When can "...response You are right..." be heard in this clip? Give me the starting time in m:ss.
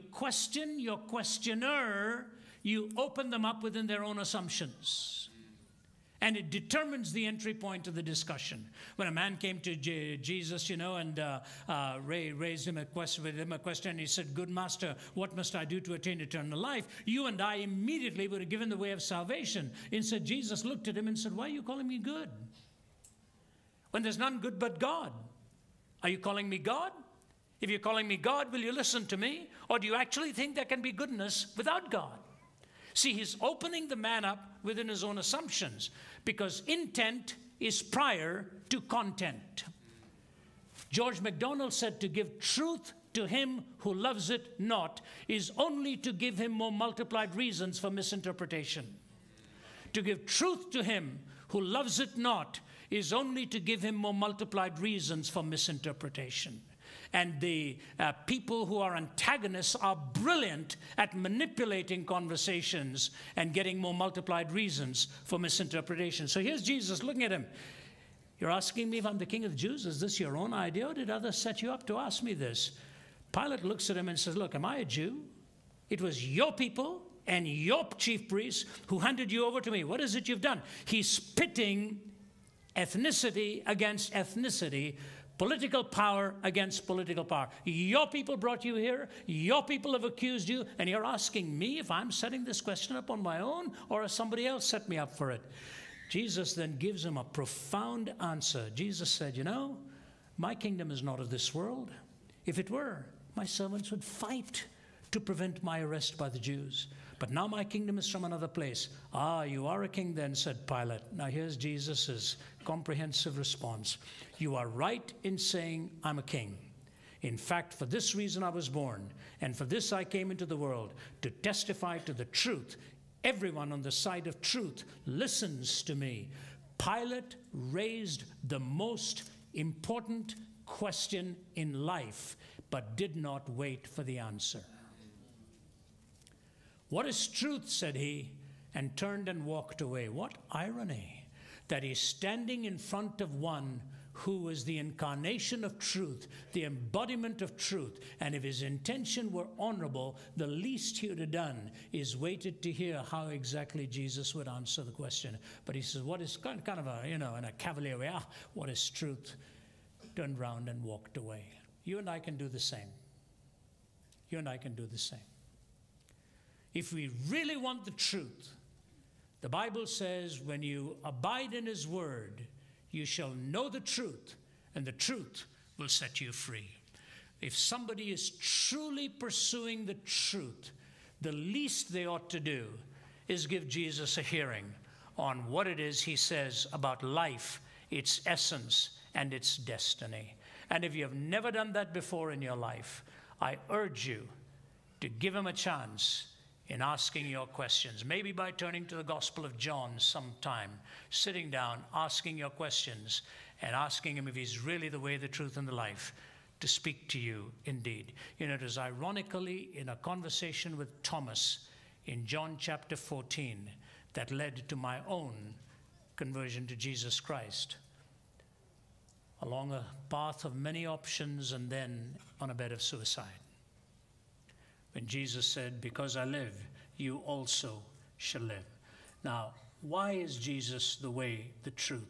1:53.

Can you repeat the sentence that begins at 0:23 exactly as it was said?
When there's none good but God, are you calling me God?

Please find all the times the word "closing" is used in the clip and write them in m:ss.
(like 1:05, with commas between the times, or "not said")
not said.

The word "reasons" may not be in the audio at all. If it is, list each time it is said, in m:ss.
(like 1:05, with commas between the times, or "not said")
0:47, 0:54, 1:04, 1:58.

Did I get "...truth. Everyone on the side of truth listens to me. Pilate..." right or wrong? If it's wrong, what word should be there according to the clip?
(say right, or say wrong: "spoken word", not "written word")
right.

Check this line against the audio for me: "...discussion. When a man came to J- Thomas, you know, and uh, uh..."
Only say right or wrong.
wrong.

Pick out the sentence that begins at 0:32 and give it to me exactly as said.
See, he's opening the man up within his own assumptions because intent is prior to content.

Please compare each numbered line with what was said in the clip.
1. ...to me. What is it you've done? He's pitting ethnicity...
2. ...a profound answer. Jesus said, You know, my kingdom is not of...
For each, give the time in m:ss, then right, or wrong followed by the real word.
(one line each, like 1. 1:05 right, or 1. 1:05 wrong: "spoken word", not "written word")
1. 1:19 right
2. 1:37 right.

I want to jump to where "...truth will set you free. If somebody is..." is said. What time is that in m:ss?
2:54.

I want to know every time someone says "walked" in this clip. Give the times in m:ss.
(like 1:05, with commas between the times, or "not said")
2:19, 2:40.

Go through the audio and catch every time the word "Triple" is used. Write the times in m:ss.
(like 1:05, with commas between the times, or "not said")
not said.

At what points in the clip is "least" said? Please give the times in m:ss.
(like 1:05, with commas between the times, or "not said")
2:30, 3:01.